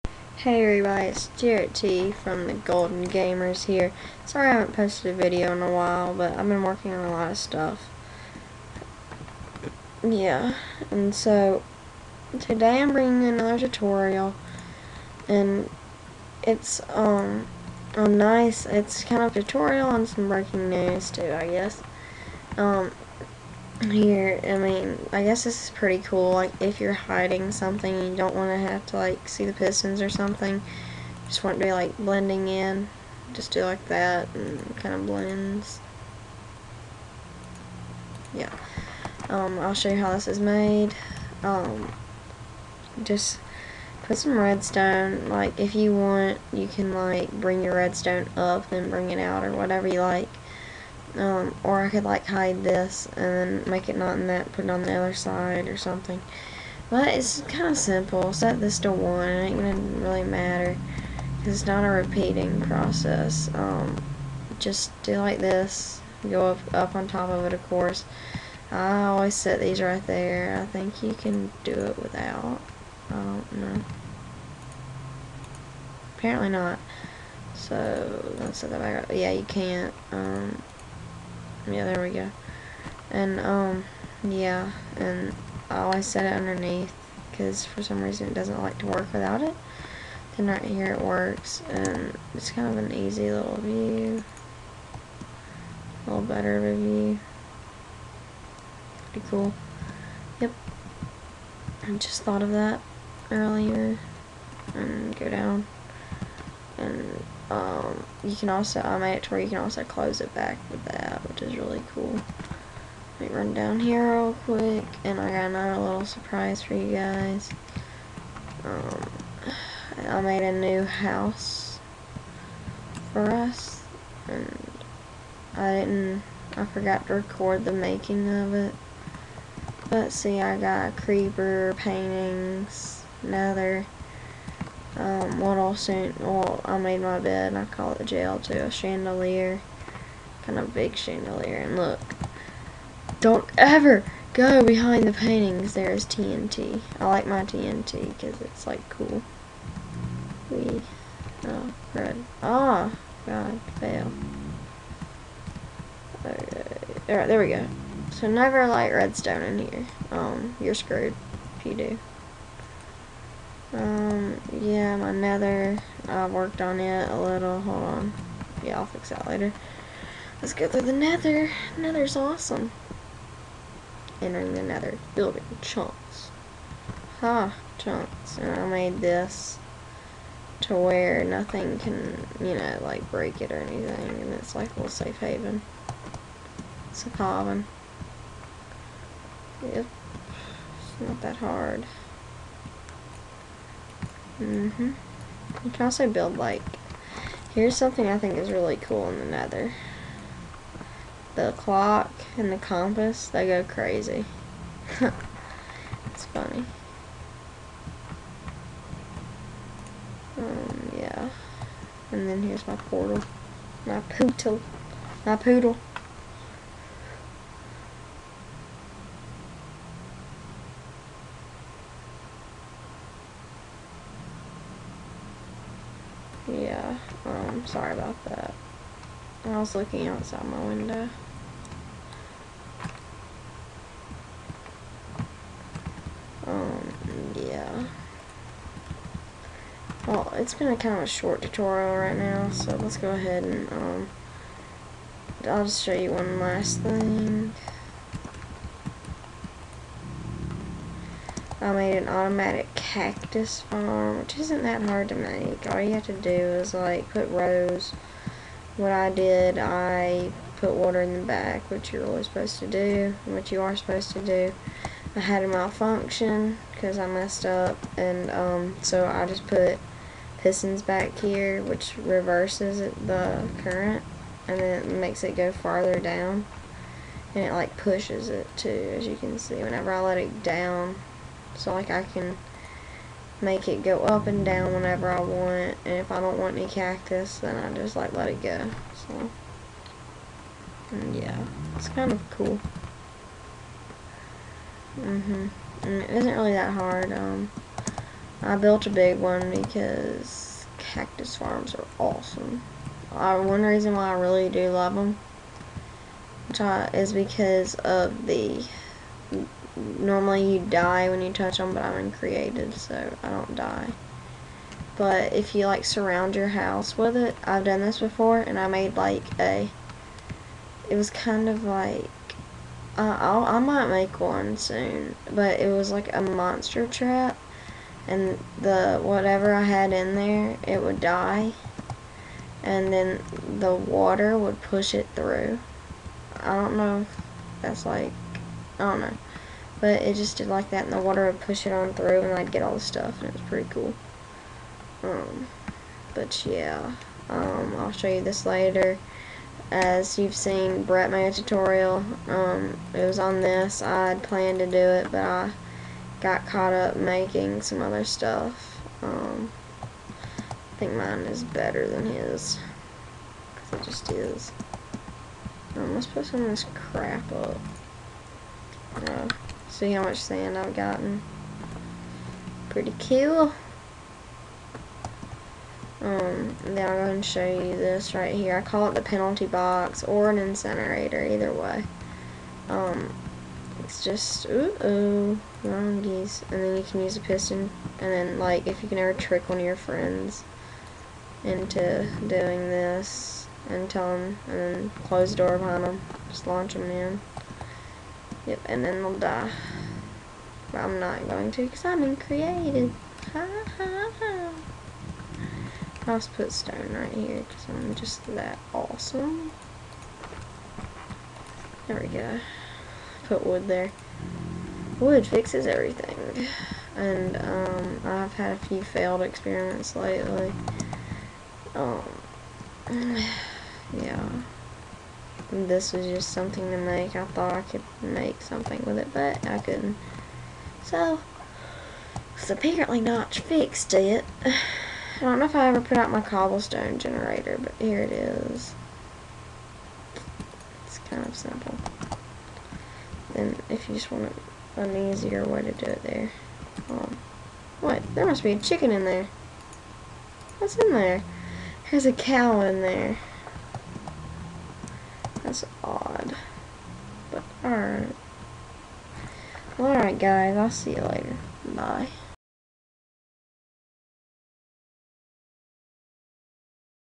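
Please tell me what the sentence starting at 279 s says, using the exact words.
Whenever I let it down, so like I can make it go up and down whenever I want.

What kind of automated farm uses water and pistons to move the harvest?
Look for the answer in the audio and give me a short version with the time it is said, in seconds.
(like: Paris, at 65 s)
Cactus farm, at 252 s.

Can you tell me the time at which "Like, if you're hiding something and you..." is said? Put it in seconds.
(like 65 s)
26 s.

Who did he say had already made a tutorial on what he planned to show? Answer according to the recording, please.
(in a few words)
Brett.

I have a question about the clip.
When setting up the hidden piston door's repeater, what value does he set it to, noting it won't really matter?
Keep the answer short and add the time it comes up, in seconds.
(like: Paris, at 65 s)
1, at 58 s.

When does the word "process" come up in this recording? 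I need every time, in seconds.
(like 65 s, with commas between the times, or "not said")
62 s.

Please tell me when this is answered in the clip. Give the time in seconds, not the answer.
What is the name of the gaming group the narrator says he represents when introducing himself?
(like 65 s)
2 s.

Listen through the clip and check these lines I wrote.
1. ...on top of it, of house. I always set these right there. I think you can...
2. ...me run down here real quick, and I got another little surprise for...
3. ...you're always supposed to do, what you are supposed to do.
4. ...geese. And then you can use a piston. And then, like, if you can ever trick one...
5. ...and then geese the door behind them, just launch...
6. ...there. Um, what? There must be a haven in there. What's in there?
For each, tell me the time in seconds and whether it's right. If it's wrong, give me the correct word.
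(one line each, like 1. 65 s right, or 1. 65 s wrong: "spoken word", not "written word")
1. 66 s wrong: "course", not "house"
2. 113 s right
3. 261 s right
4. 386 s right
5. 394 s wrong: "close", not "geese"
6. 446 s wrong: "chicken", not "haven".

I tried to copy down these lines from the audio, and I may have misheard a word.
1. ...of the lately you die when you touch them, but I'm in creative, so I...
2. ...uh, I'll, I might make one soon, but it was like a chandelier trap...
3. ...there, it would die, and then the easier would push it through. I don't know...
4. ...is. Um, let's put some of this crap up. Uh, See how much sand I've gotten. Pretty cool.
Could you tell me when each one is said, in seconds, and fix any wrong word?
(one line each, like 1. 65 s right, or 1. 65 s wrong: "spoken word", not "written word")
1. 307 s wrong: "normally", not "lately"
2. 322 s wrong: "monster", not "chandelier"
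3. 330 s wrong: "water", not "easier"
4. 364 s right.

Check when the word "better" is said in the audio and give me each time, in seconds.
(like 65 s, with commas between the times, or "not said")
96 s, 361 s.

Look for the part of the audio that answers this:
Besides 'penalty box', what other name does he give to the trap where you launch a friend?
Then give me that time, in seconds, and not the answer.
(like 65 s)
380 s.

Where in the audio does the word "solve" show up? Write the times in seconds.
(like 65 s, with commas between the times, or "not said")
not said.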